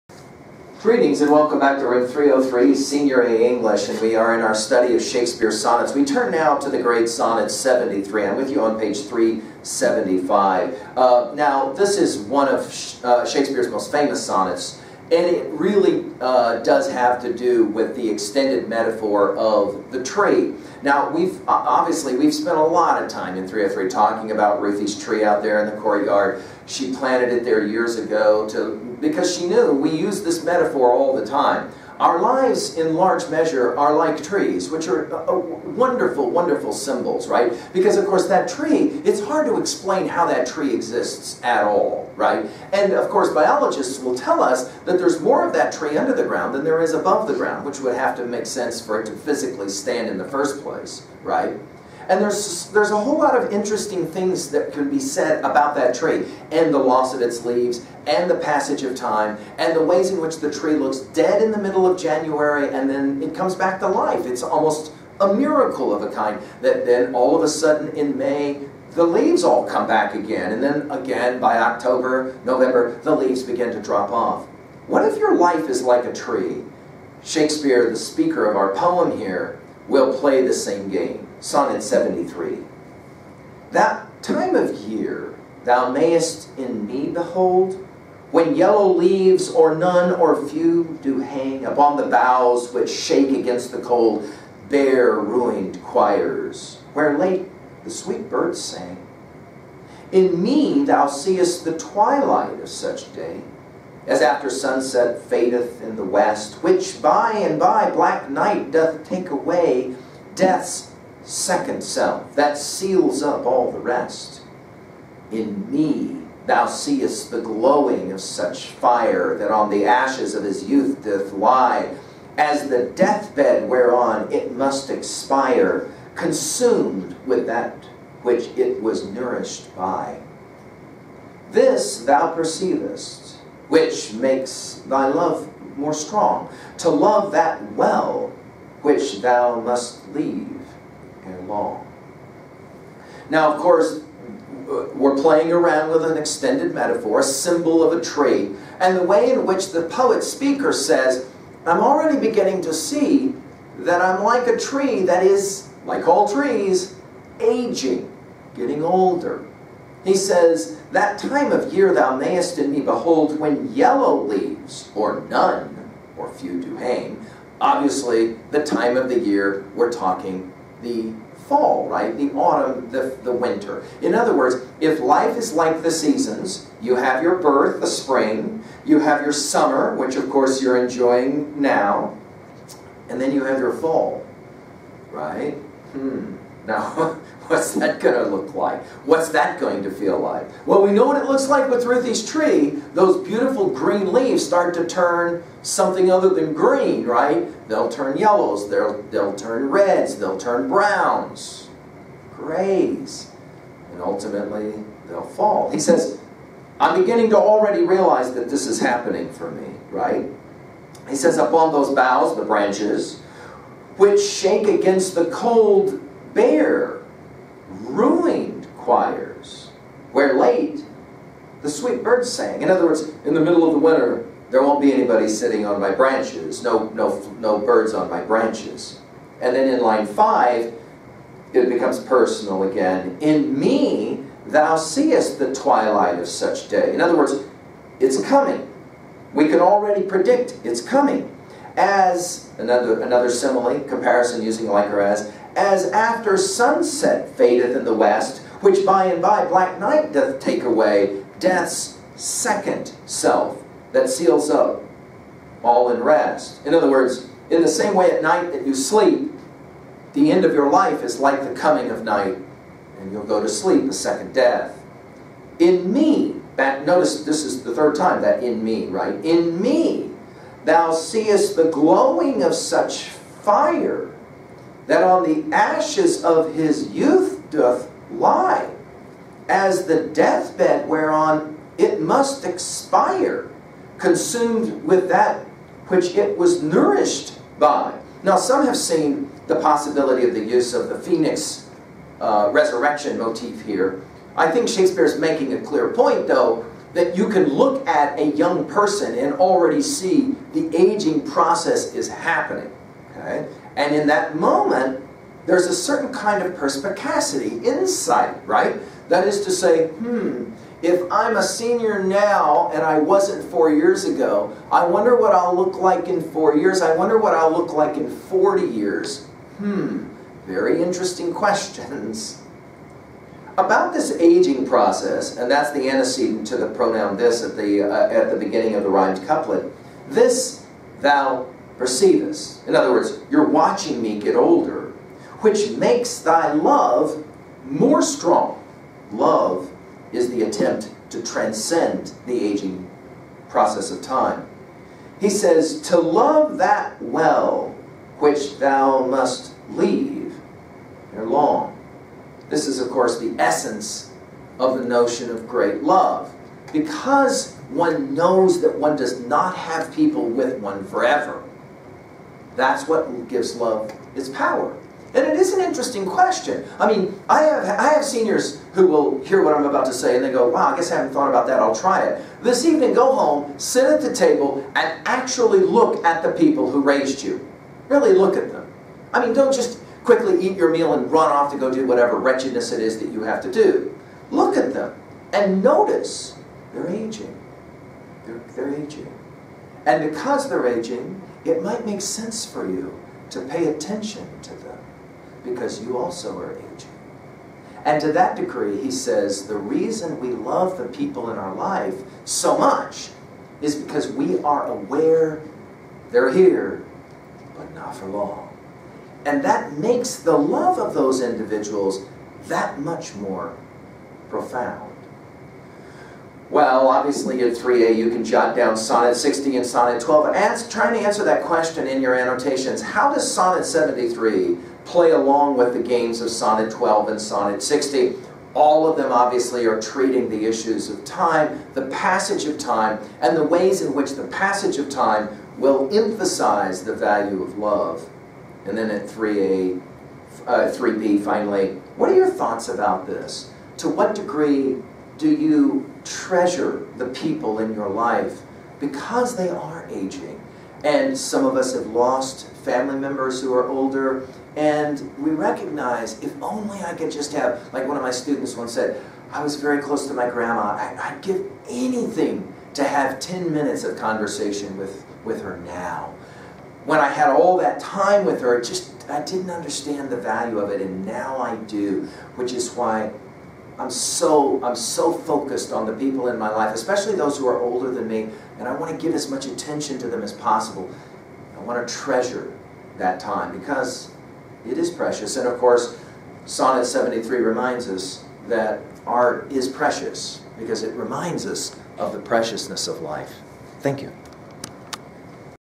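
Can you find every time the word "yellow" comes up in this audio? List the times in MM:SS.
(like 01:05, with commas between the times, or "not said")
01:28, 02:43, 03:18.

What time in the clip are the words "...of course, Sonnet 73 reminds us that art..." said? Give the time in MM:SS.
08:05.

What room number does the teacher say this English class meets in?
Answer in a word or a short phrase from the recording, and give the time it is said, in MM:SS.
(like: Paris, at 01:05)
303, at 00:01.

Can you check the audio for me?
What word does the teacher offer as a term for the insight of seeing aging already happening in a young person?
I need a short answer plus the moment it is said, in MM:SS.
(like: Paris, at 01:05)
perspicacity, at 05:06.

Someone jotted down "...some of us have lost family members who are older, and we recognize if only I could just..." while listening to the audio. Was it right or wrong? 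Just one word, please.
right.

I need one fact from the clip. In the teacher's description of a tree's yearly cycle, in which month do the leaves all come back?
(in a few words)
May.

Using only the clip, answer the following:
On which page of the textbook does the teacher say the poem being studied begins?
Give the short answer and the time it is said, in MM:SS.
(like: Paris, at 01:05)
375, at 00:08.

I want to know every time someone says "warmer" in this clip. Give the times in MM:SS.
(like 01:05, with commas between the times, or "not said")
not said.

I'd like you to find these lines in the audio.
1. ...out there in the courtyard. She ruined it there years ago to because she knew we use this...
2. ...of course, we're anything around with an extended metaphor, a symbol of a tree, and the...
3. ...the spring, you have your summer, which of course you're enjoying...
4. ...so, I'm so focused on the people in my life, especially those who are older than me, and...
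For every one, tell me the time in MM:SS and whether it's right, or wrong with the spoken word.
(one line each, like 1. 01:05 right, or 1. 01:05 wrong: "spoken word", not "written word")
1. 00:25 wrong: "planted", not "ruined"
2. 02:23 wrong: "playing", not "anything"
3. 02:57 right
4. 07:53 right.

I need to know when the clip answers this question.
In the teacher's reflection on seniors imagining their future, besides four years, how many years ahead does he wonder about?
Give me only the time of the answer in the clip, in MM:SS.
05:18.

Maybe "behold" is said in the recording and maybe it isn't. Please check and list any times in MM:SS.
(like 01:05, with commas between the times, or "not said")
01:27, 02:42.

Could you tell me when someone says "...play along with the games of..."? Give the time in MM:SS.
07:04.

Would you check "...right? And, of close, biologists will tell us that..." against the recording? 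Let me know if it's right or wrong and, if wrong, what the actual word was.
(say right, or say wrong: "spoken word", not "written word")
wrong: "course", not "close".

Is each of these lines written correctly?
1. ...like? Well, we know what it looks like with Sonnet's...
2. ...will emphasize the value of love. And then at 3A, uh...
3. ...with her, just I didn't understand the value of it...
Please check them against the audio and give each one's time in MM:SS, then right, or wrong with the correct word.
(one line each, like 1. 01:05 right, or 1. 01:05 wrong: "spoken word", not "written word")
1. 03:10 wrong: "Ruthie", not "Sonnet"
2. 07:15 right
3. 07:48 right.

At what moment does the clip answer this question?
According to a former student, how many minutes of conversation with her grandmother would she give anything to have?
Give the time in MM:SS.
07:43.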